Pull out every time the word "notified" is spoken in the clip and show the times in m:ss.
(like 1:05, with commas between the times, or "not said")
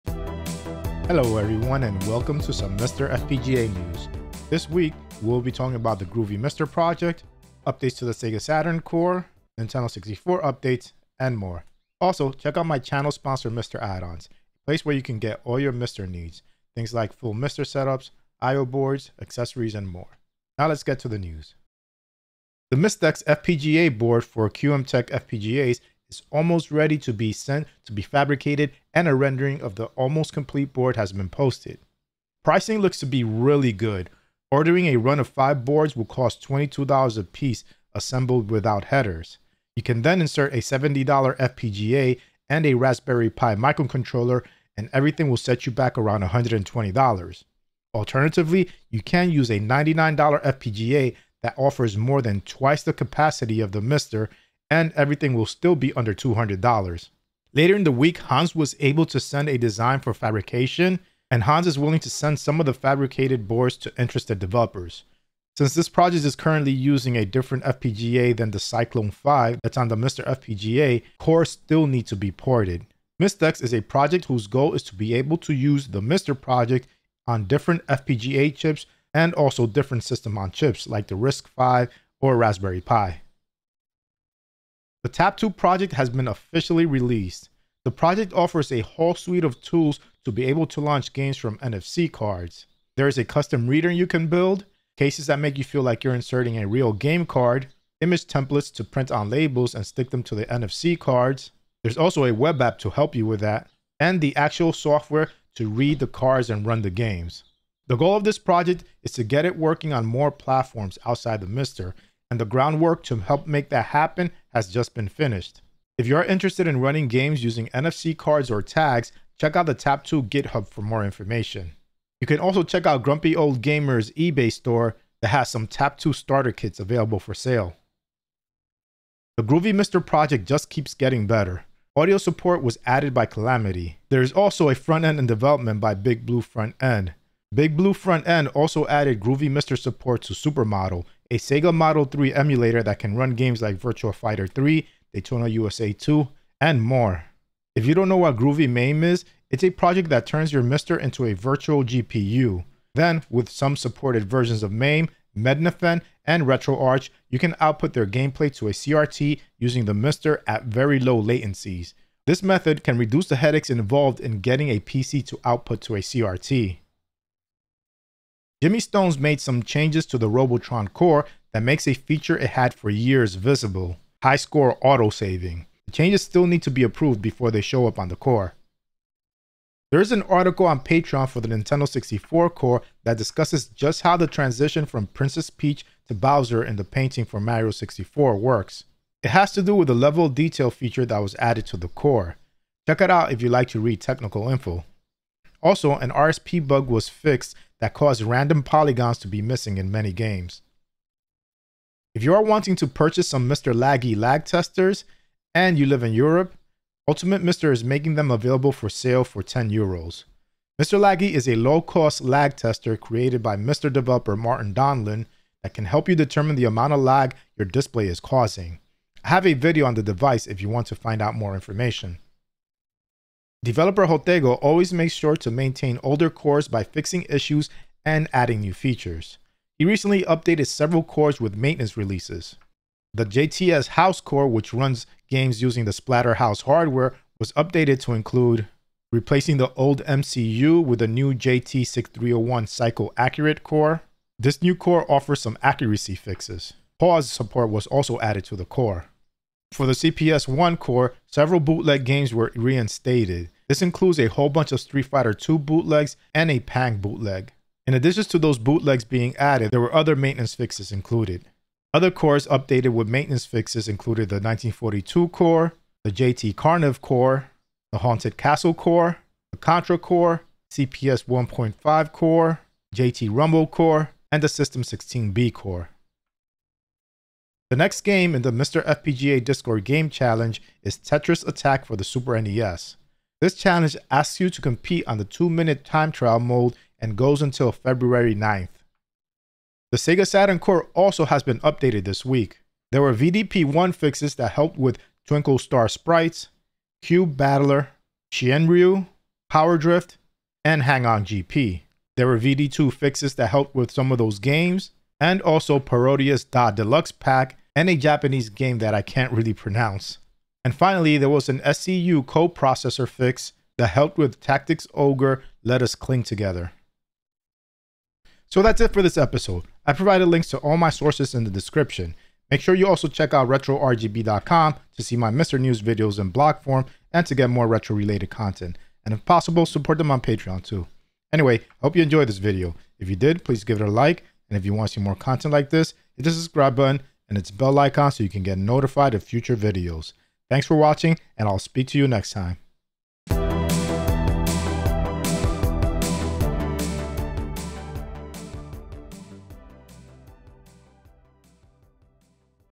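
5:38.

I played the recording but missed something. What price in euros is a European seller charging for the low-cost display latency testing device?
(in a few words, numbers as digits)
10 euros.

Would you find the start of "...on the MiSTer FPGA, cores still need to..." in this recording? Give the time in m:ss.
1:09.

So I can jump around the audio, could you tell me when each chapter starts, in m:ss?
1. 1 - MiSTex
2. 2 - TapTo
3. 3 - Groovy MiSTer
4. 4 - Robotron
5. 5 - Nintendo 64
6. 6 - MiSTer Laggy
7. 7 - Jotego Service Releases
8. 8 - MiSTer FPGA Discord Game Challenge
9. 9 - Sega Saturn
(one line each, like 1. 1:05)
1. 0:22
2. 1:24
3. 2:08
4. 2:48
5. 2:59
6. 3:21
7. 3:43
8. 4:37
9. 4:49.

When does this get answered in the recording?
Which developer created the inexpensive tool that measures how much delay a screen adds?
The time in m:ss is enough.
3:34.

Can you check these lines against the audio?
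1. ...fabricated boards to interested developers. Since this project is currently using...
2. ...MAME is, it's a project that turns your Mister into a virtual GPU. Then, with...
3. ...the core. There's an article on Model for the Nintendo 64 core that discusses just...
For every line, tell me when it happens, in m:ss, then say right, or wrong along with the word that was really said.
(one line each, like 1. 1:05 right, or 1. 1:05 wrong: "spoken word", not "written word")
1. 1:02 right
2. 2:28 right
3. 2:58 wrong: "Patreon", not "Model".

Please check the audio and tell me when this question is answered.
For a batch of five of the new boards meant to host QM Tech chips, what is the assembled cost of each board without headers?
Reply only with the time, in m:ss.
0:36.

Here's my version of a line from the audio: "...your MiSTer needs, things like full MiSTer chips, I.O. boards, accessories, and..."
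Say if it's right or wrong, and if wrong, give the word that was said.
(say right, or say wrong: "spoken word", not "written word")
wrong: "setups", not "chips".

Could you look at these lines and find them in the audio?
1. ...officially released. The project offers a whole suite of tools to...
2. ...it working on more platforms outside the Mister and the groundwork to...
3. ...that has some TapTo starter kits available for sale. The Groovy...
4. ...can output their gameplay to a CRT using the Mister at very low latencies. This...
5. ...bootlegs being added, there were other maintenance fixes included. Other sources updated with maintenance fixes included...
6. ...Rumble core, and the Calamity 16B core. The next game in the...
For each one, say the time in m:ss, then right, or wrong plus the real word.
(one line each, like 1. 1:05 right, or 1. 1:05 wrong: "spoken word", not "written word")
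1. 1:26 right
2. 1:49 right
3. 2:05 right
4. 2:37 right
5. 4:18 wrong: "cores", not "sources"
6. 4:33 wrong: "System", not "Calamity".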